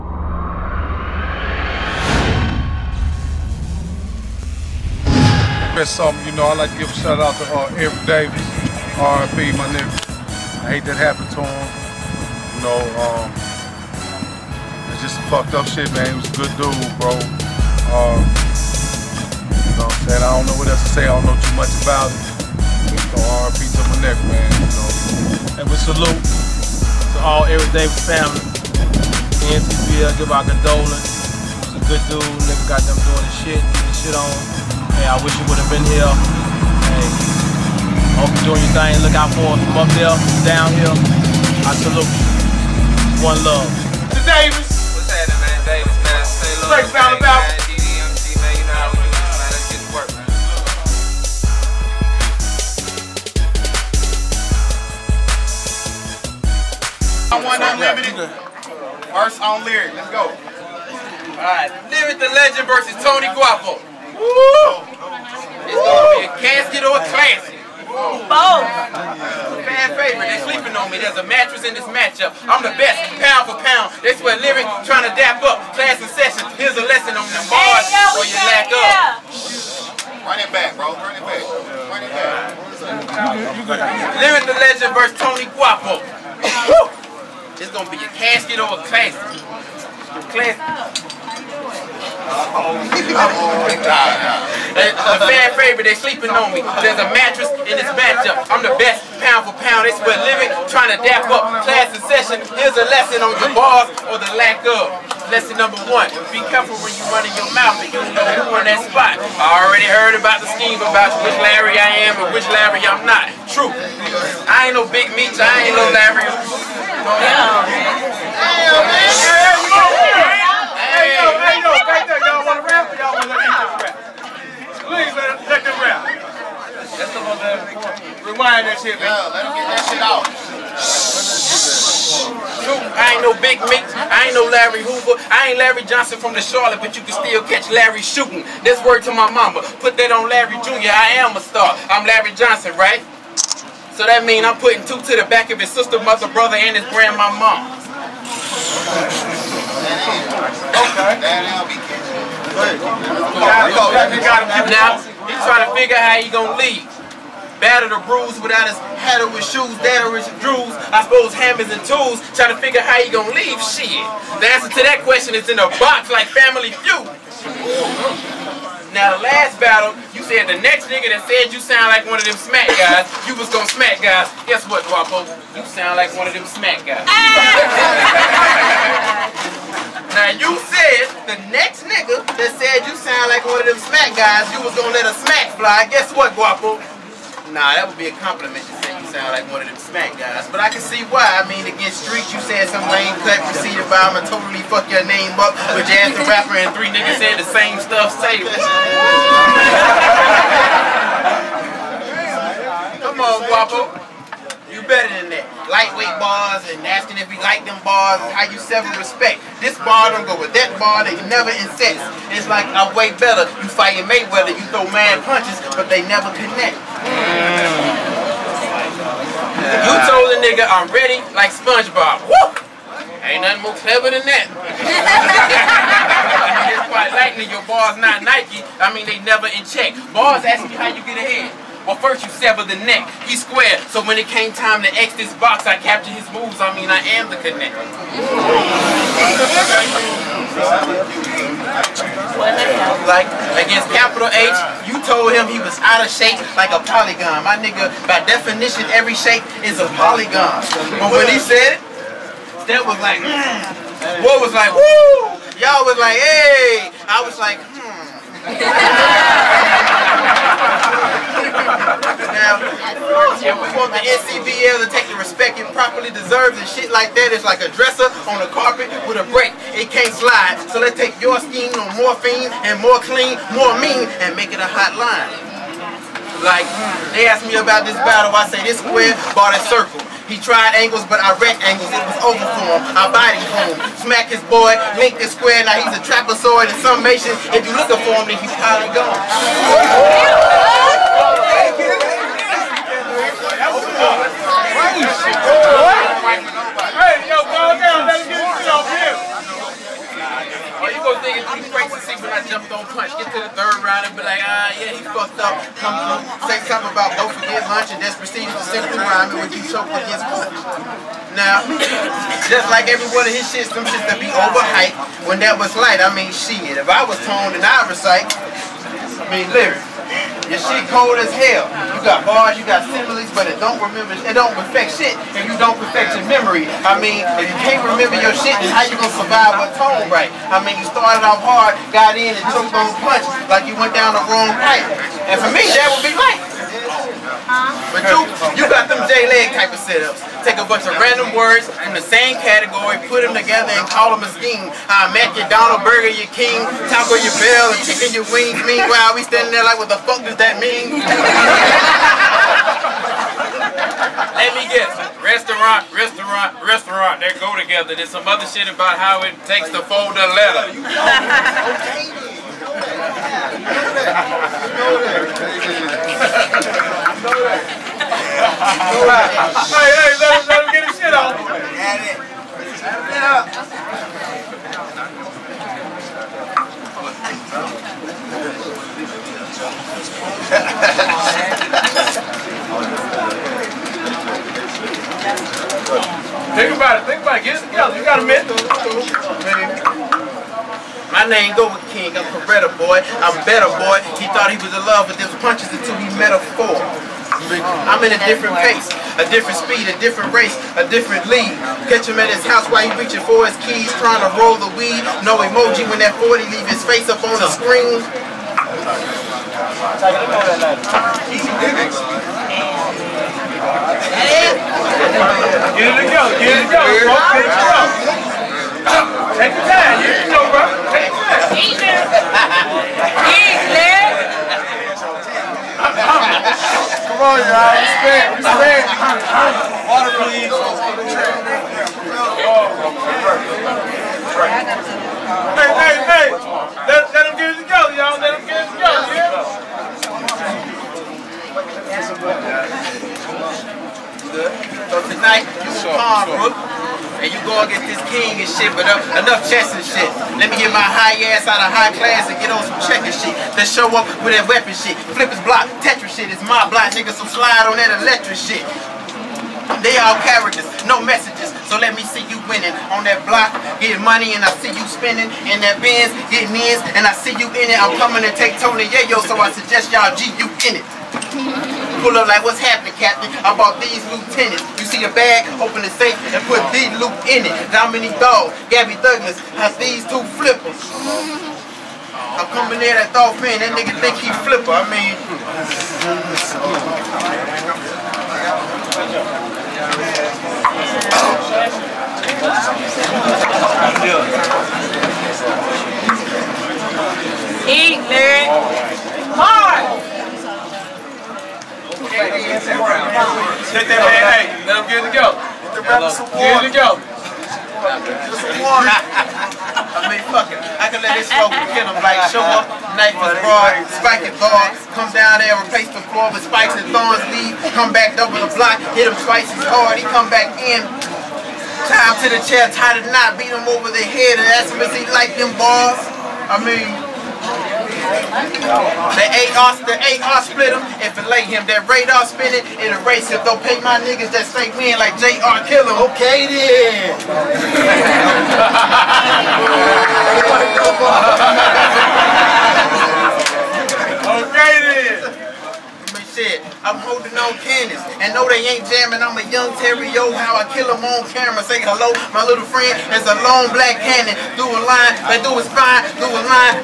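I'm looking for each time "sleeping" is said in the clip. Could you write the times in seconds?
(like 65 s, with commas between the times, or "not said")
70 s, 95 s.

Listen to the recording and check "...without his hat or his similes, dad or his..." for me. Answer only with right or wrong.
wrong.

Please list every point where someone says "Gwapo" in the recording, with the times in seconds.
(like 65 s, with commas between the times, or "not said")
63 s, 85 s, 174 s, 186 s, 203 s.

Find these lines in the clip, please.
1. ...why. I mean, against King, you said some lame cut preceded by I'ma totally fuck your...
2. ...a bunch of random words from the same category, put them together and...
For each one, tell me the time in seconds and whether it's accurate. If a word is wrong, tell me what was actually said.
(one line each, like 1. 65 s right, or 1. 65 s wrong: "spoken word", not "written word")
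1. 191 s wrong: "Street", not "King"
2. 340 s right.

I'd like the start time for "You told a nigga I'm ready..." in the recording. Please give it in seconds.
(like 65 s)
219 s.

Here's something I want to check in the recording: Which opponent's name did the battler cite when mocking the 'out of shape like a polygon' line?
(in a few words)
Capital H.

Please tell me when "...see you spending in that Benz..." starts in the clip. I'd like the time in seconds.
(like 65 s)
464 s.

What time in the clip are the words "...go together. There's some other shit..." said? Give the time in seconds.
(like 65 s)
357 s.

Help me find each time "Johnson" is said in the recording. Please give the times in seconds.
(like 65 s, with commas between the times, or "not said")
135 s, 142 s.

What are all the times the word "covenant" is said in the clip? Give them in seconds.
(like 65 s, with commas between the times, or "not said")
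not said.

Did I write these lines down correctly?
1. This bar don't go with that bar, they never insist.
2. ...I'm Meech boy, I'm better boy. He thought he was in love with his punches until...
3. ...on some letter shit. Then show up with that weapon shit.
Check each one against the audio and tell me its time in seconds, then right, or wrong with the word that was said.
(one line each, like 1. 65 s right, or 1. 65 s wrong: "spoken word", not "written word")
1. 209 s right
2. 392 s wrong: "Beretta", not "Meech"
3. 452 s wrong: "checker", not "letter".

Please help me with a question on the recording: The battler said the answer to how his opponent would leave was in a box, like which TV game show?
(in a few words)
Family Feud.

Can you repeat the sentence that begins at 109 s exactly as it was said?
I already heard about the scheme about which Larry I am and which Larry I'm not.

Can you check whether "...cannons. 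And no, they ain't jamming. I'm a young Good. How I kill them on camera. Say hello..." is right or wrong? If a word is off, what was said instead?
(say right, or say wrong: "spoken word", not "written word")
wrong: "Terrio", not "Good".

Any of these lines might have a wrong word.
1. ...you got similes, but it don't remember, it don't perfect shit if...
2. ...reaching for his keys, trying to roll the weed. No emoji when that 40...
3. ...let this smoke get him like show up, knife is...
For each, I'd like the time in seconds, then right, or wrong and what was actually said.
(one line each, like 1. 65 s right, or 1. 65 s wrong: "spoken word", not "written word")
1. 322 s right
2. 402 s right
3. 511 s right.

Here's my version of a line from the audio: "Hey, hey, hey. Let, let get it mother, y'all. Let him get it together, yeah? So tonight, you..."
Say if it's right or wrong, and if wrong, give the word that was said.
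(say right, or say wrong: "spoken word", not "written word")
wrong: "together", not "mother".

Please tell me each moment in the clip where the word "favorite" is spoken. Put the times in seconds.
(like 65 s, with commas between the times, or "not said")
69 s, 95 s.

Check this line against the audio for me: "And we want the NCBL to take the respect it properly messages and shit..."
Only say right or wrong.
wrong.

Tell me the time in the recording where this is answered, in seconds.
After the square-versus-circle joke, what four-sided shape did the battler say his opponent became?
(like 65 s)
286 s.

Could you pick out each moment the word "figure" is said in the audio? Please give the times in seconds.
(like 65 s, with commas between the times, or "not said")
155 s, 162 s.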